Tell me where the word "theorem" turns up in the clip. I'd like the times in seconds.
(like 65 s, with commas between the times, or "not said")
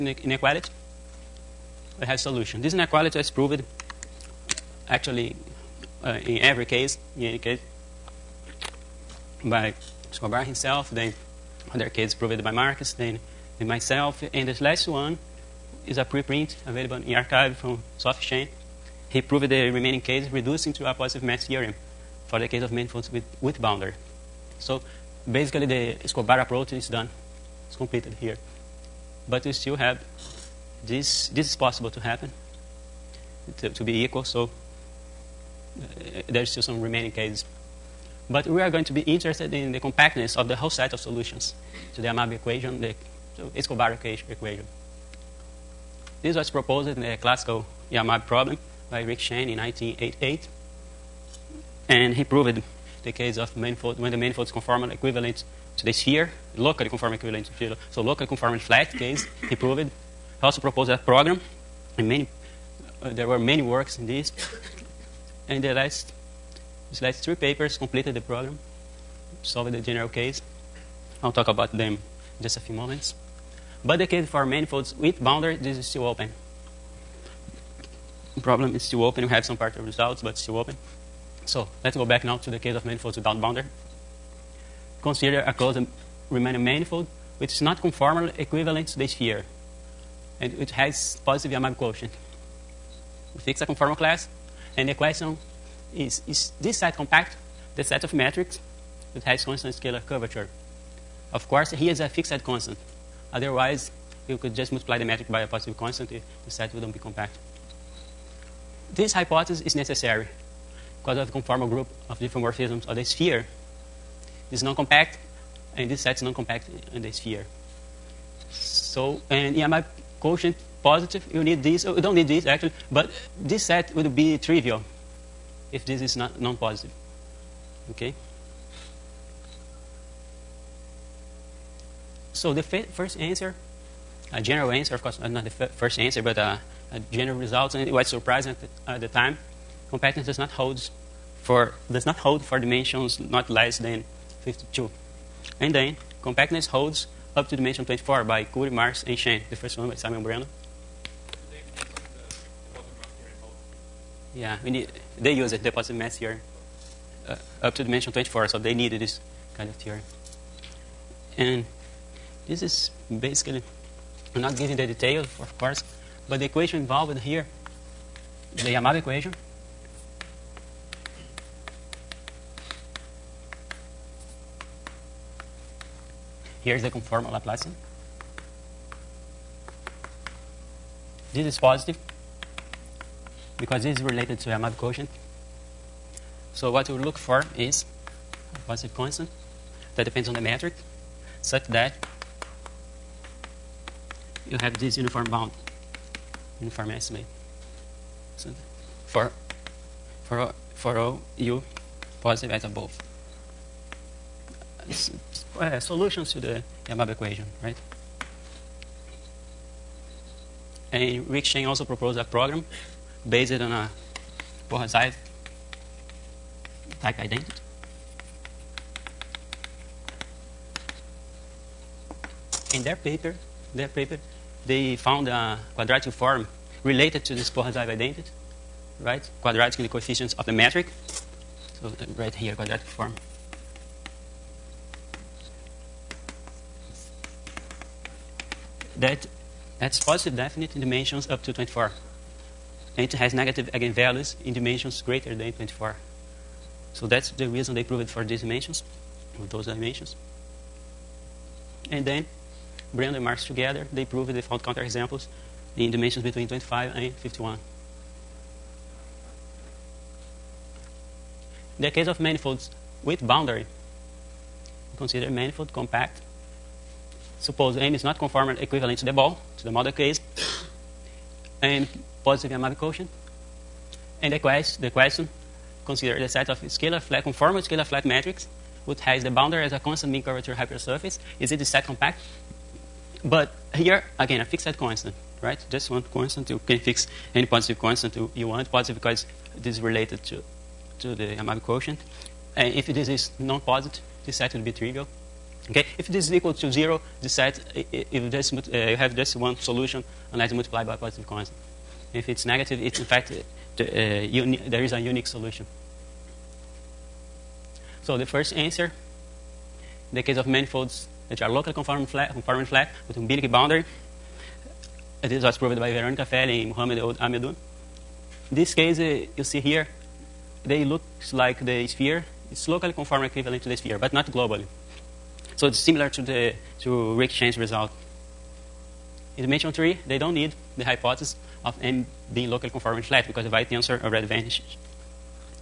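21 s, 159 s.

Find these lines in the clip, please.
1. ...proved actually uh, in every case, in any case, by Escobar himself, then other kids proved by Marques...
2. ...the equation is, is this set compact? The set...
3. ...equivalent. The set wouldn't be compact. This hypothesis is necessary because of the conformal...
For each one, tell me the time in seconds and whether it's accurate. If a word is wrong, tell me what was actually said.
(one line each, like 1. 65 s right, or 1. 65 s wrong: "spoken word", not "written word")
1. 3 s right
2. 94 s wrong: "question", not "equation"
3. 105 s wrong: "constant", not "equivalent".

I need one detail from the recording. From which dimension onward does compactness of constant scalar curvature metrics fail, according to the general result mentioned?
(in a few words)
52.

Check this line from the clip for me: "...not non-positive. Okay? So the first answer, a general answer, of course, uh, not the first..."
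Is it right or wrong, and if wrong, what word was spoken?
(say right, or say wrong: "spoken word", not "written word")
right.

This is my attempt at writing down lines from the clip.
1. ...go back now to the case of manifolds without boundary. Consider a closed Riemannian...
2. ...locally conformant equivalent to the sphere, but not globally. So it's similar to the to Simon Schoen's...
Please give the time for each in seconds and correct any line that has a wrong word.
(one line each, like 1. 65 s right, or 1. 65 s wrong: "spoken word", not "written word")
1. 81 s right
2. 322 s wrong: "Rick", not "Simon".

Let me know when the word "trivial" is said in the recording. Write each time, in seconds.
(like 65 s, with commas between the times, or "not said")
124 s, 294 s.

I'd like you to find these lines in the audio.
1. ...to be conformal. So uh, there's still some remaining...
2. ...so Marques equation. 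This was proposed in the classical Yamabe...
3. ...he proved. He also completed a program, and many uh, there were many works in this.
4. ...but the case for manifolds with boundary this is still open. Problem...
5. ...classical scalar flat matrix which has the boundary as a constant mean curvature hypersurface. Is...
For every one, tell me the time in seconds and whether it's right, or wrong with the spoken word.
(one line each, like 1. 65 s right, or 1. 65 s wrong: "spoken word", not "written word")
1. 33 s wrong: "equal", not "conformal"
2. 43 s wrong: "Escobar", not "Marques"
3. 59 s wrong: "proposed", not "completed"
4. 73 s right
5. 277 s wrong: "conformal", not "classical".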